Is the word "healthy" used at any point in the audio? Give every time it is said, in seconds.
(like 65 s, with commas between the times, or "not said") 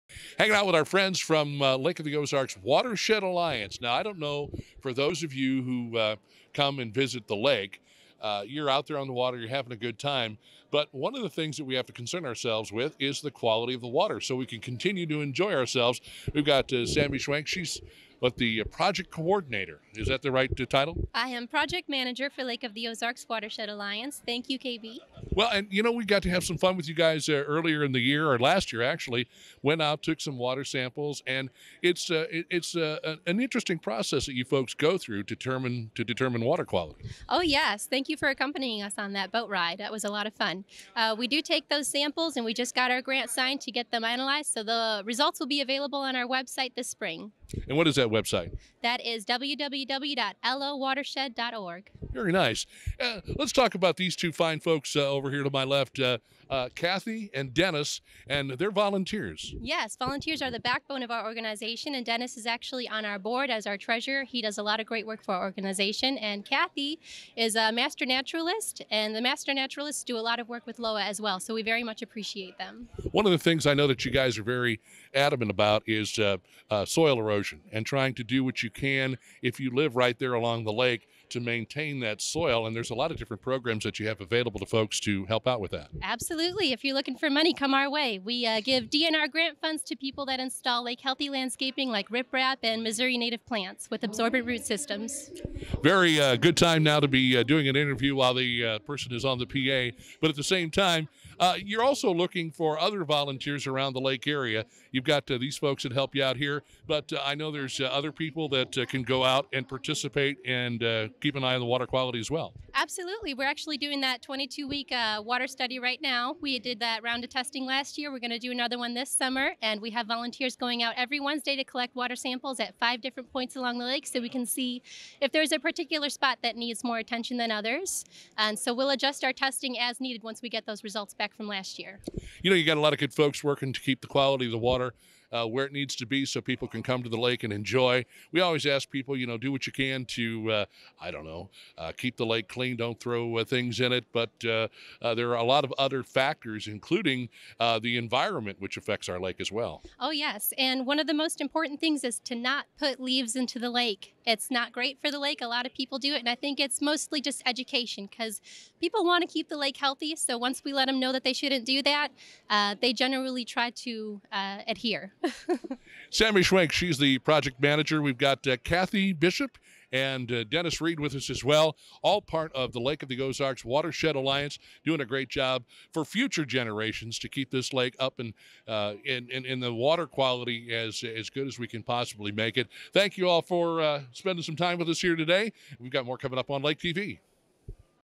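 91 s, 159 s.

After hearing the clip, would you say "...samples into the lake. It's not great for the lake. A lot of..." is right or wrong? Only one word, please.
wrong.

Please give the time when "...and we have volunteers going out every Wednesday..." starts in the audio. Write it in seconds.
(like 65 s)
119 s.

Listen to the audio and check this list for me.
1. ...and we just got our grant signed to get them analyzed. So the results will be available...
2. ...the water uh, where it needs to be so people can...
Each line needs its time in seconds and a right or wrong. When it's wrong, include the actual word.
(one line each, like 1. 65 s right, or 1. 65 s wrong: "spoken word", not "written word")
1. 42 s right
2. 134 s right.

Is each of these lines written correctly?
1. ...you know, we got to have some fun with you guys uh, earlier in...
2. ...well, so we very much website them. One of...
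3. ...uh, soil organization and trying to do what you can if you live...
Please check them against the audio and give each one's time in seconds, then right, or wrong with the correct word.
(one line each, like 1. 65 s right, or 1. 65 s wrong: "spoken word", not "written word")
1. 25 s right
2. 71 s wrong: "appreciate", not "website"
3. 76 s wrong: "erosion", not "organization".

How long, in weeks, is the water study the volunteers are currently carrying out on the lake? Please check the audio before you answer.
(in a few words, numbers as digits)
22 weeks.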